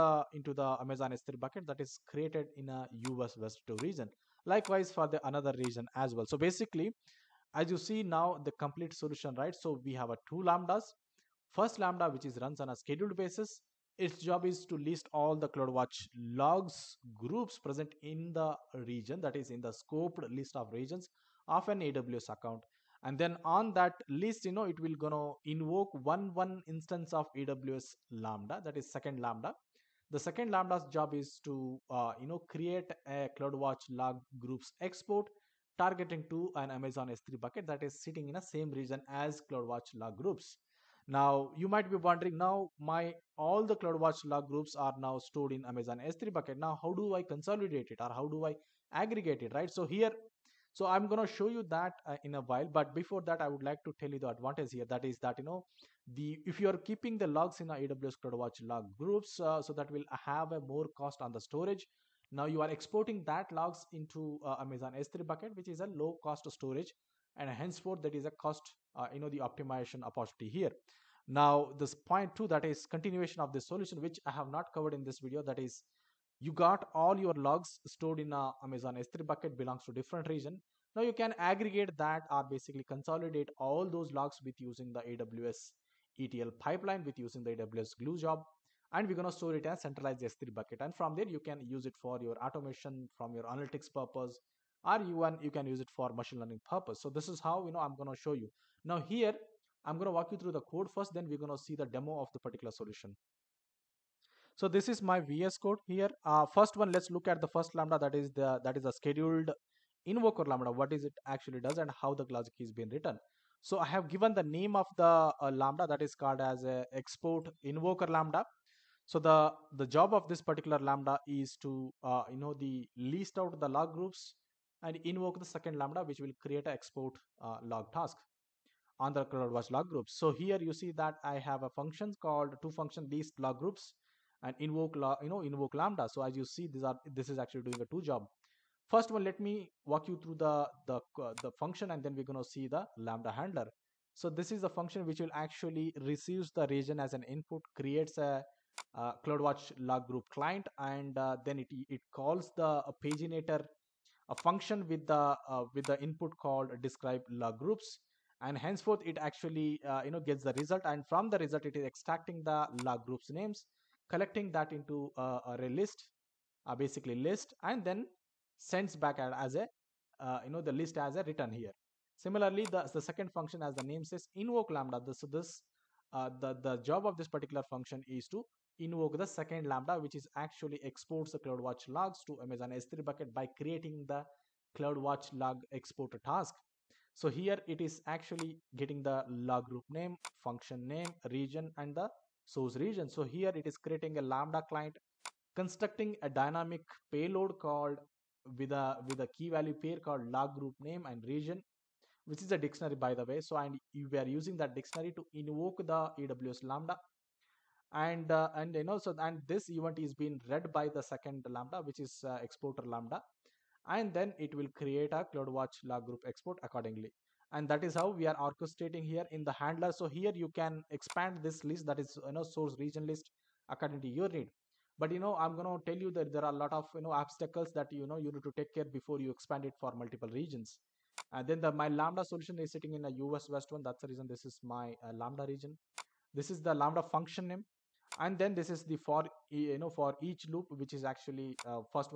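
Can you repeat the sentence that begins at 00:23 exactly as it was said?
And then on that list, you know, it will gonna invoke one one instance of AWS Lambda, that is second Lambda.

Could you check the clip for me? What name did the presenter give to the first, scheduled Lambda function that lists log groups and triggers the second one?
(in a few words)
Export invoker lambda.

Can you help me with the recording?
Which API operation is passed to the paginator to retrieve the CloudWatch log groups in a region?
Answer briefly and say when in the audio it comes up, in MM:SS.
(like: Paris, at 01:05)
Describe log groups, at 02:36.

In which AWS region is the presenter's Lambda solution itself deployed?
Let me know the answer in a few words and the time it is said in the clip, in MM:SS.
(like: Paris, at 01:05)
us-west-1, at 03:53.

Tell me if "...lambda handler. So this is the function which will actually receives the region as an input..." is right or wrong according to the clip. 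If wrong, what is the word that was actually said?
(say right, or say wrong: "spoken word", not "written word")
right.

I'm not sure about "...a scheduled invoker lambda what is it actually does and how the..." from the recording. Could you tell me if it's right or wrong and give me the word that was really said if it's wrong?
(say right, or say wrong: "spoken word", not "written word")
right.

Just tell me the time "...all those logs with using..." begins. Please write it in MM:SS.
01:23.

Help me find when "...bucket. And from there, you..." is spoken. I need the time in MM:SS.
01:30.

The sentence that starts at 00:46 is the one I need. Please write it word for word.
Now how do I consolidate it or how do I aggregate it, right?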